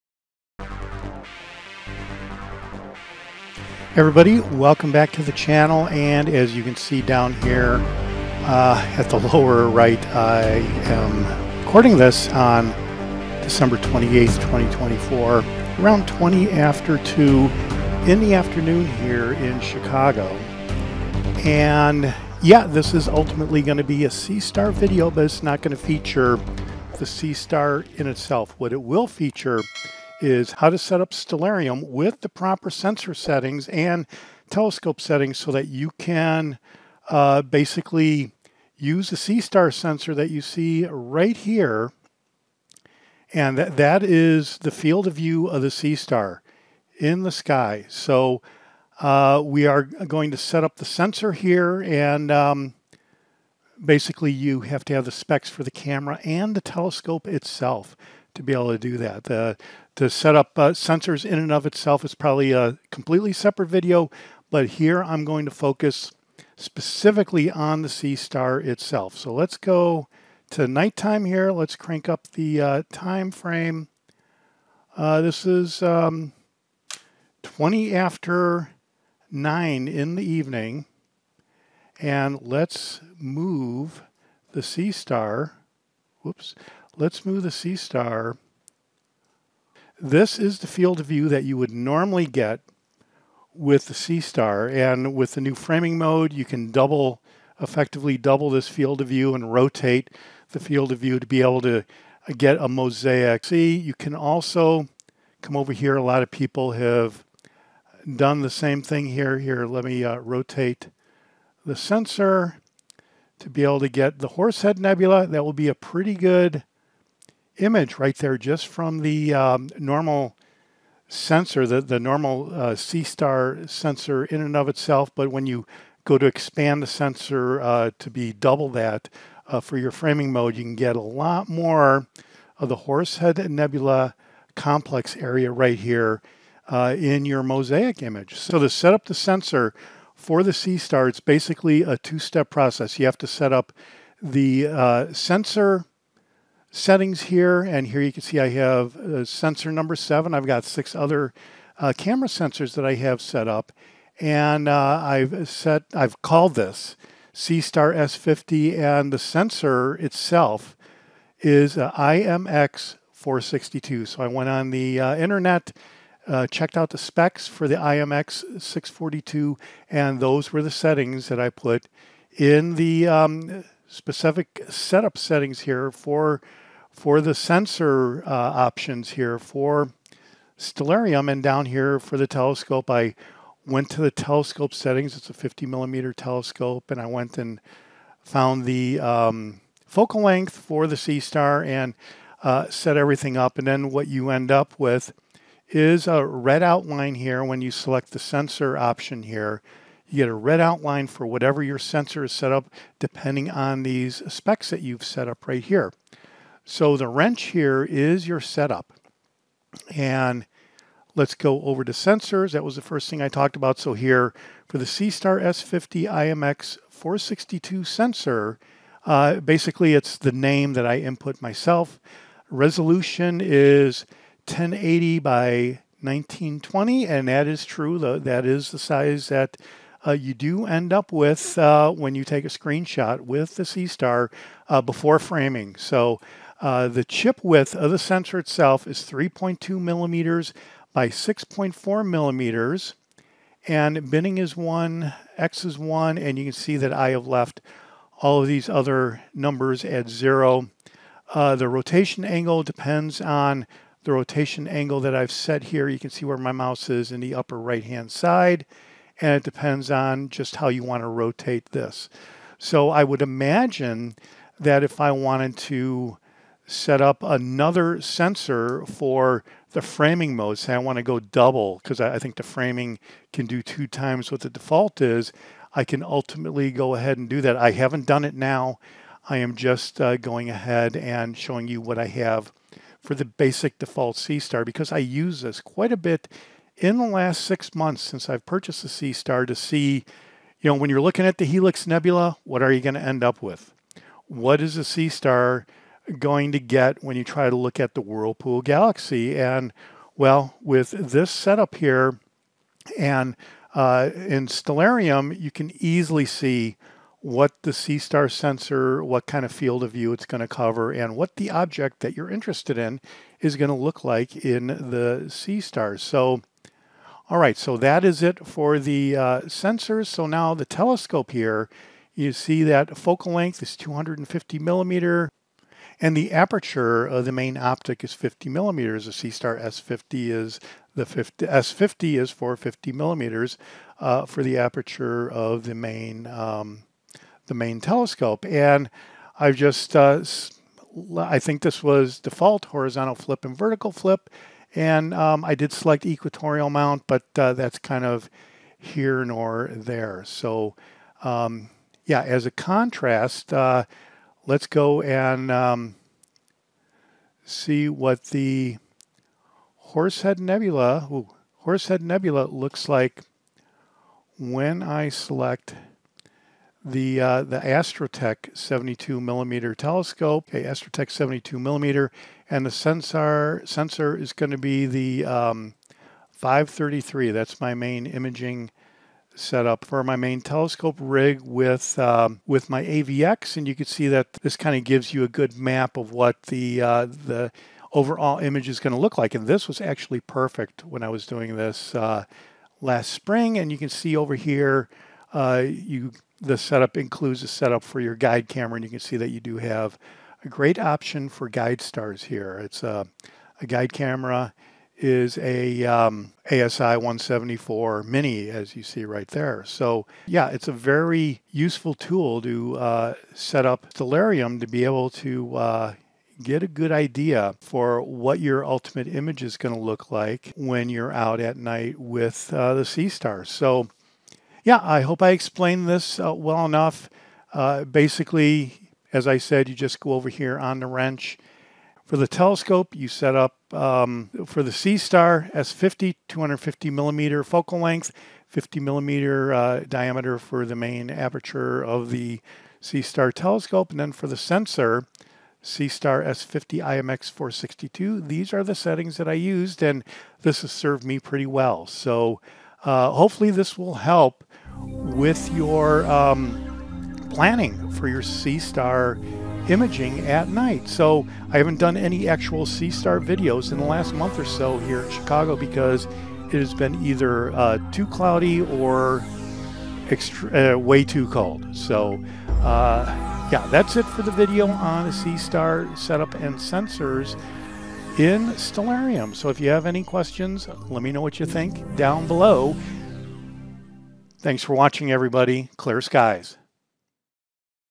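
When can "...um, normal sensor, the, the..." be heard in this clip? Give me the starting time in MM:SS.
01:59.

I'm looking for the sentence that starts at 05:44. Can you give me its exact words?
And um, I did select equatorial mount, but uh, that's kind of here nor there.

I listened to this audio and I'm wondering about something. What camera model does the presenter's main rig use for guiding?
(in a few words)
ASI 174 Mini.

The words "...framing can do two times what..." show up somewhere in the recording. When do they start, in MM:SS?
04:32.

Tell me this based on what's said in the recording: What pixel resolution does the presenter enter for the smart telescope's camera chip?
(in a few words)
1080 by 1920.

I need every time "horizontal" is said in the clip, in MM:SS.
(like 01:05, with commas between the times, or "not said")
05:42.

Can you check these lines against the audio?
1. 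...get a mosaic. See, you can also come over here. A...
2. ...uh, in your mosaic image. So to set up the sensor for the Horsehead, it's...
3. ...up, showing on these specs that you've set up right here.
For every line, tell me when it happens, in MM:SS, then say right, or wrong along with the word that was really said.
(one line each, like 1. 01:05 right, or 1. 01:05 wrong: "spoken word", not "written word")
1. 01:42 right
2. 02:16 wrong: "Seestar", not "Horsehead"
3. 03:22 wrong: "depending", not "showing".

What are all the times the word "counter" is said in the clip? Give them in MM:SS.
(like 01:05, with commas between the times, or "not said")
not said.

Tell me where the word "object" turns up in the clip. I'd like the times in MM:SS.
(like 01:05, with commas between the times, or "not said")
05:11.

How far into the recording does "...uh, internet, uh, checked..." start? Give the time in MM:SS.
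02:44.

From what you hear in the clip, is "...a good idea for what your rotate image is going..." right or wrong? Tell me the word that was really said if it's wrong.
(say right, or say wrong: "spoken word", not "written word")
wrong: "ultimate", not "rotate".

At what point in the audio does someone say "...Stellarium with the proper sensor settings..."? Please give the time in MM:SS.
00:31.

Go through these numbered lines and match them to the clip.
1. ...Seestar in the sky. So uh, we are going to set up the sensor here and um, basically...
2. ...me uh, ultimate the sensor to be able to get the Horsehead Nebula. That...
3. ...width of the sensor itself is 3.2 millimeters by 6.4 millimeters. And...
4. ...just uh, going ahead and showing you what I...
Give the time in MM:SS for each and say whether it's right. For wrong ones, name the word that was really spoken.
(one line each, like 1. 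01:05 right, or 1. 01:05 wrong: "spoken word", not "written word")
1. 00:45 right
2. 01:49 wrong: "rotate", not "ultimate"
3. 03:57 right
4. 04:39 right.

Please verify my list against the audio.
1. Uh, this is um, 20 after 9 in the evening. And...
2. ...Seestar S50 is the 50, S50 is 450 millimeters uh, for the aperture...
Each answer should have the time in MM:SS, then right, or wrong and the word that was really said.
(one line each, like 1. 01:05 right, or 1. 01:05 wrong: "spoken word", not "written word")
1. 01:14 right
2. 05:29 right.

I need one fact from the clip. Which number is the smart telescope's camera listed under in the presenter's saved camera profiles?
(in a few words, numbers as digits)
7.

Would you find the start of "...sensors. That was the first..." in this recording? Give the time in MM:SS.
03:31.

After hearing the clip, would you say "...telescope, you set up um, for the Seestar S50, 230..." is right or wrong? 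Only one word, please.
wrong.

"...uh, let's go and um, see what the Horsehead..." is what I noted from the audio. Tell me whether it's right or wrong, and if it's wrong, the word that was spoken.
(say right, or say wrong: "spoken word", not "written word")
right.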